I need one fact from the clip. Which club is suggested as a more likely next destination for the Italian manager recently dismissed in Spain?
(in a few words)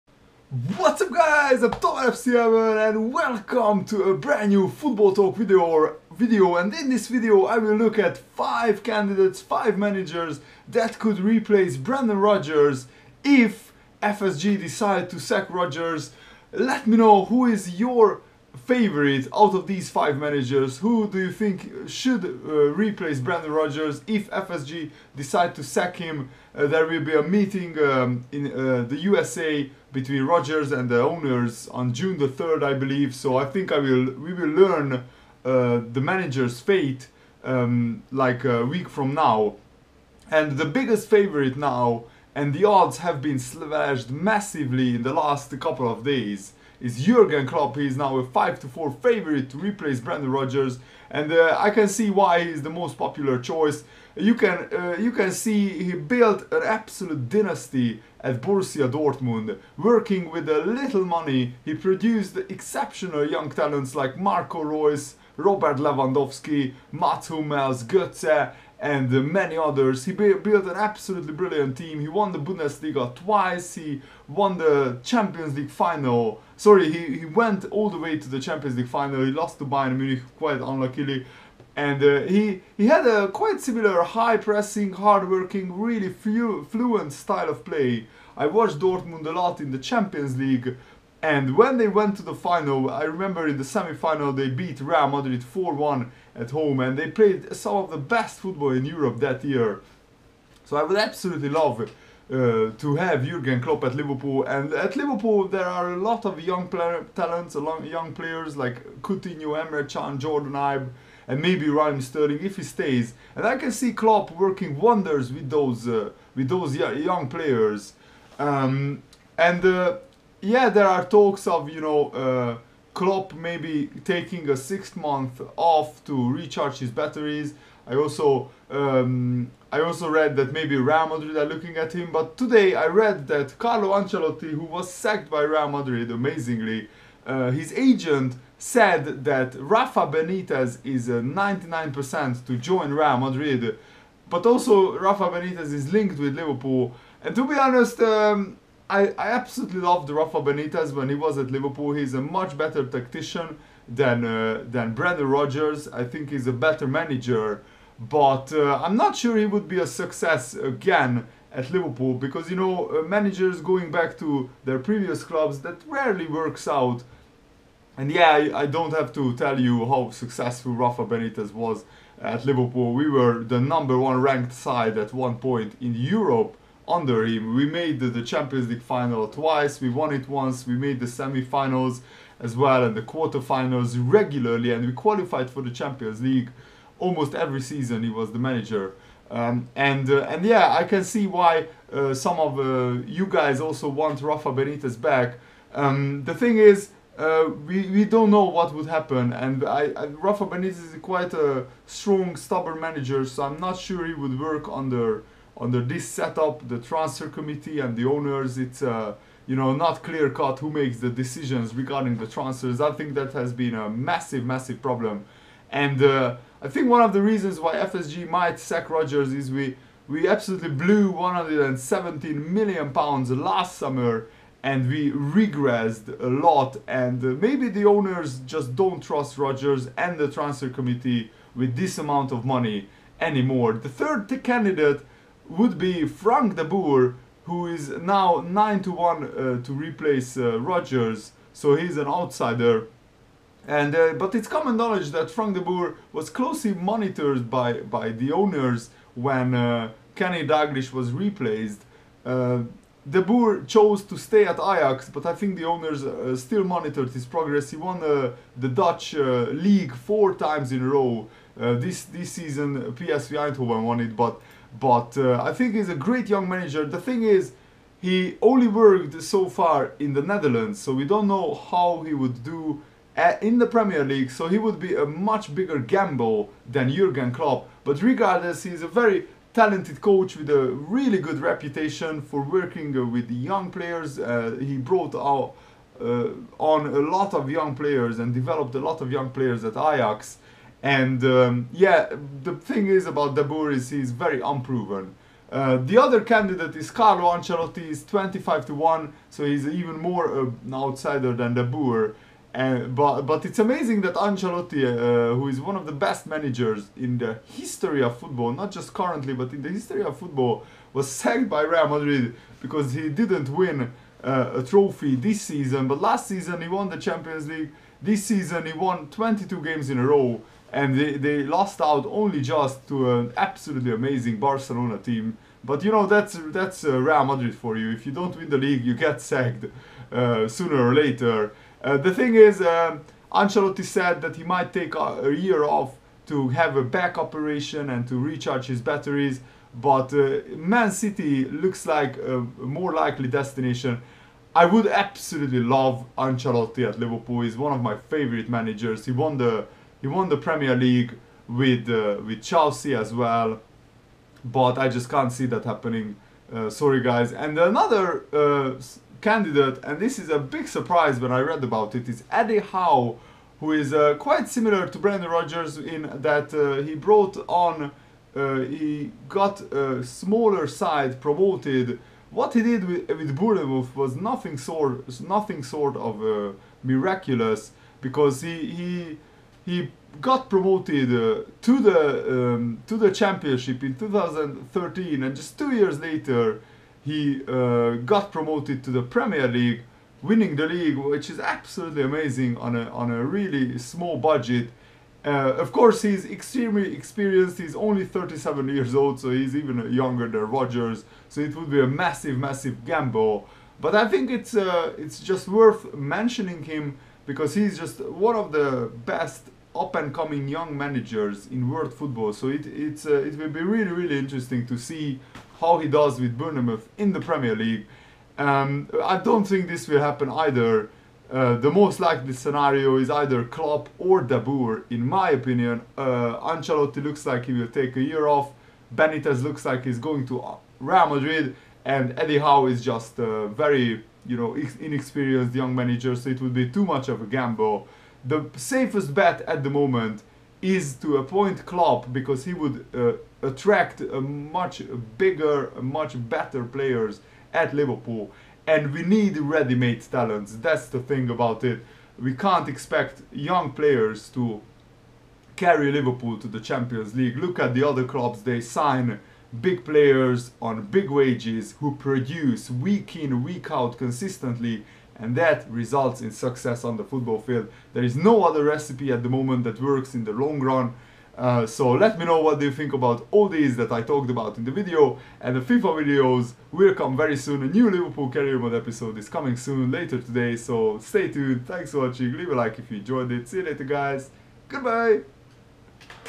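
Man City.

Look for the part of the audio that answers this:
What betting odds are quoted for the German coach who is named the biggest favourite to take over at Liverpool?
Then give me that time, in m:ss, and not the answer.
0:48.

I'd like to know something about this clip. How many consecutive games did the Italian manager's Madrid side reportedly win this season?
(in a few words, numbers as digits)
22.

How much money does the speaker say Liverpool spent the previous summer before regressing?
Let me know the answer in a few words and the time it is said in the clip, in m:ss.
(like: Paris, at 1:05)
£117 million, at 3:41.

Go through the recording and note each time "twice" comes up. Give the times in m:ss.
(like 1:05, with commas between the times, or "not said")
1:13, 2:59.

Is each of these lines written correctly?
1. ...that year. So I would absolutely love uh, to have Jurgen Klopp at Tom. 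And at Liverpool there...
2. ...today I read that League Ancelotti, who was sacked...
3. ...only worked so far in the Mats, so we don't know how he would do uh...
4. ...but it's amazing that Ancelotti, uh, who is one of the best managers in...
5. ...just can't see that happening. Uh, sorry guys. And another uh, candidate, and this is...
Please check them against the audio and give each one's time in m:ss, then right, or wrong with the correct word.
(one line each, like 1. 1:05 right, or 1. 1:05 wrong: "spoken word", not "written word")
1. 1:39 wrong: "Liverpool", not "Tom"
2. 2:12 wrong: "Carlo", not "League"
3. 4:28 wrong: "Netherlands", not "Mats"
4. 5:03 right
5. 5:54 right.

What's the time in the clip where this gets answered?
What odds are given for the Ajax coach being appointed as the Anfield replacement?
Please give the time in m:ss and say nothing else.
3:58.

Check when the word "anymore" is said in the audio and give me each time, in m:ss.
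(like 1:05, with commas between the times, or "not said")
3:53.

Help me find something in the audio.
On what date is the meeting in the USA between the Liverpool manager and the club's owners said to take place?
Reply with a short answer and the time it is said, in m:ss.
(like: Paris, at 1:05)
June 3, at 0:31.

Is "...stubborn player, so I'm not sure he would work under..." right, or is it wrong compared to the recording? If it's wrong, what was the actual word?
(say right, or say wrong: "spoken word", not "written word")
wrong: "manager", not "player".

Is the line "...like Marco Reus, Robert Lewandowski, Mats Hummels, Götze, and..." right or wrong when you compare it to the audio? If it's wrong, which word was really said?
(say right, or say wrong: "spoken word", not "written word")
right.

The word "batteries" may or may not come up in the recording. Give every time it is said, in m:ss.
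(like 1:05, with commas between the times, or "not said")
2:06, 5:38.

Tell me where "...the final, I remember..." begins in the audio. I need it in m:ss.
1:32.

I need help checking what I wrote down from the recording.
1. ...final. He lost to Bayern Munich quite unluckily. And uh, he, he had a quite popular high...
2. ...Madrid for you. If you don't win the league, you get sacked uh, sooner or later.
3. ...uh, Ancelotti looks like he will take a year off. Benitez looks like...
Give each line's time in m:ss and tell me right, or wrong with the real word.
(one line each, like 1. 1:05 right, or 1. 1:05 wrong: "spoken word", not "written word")
1. 1:18 wrong: "similar", not "popular"
2. 5:27 right
3. 7:05 right.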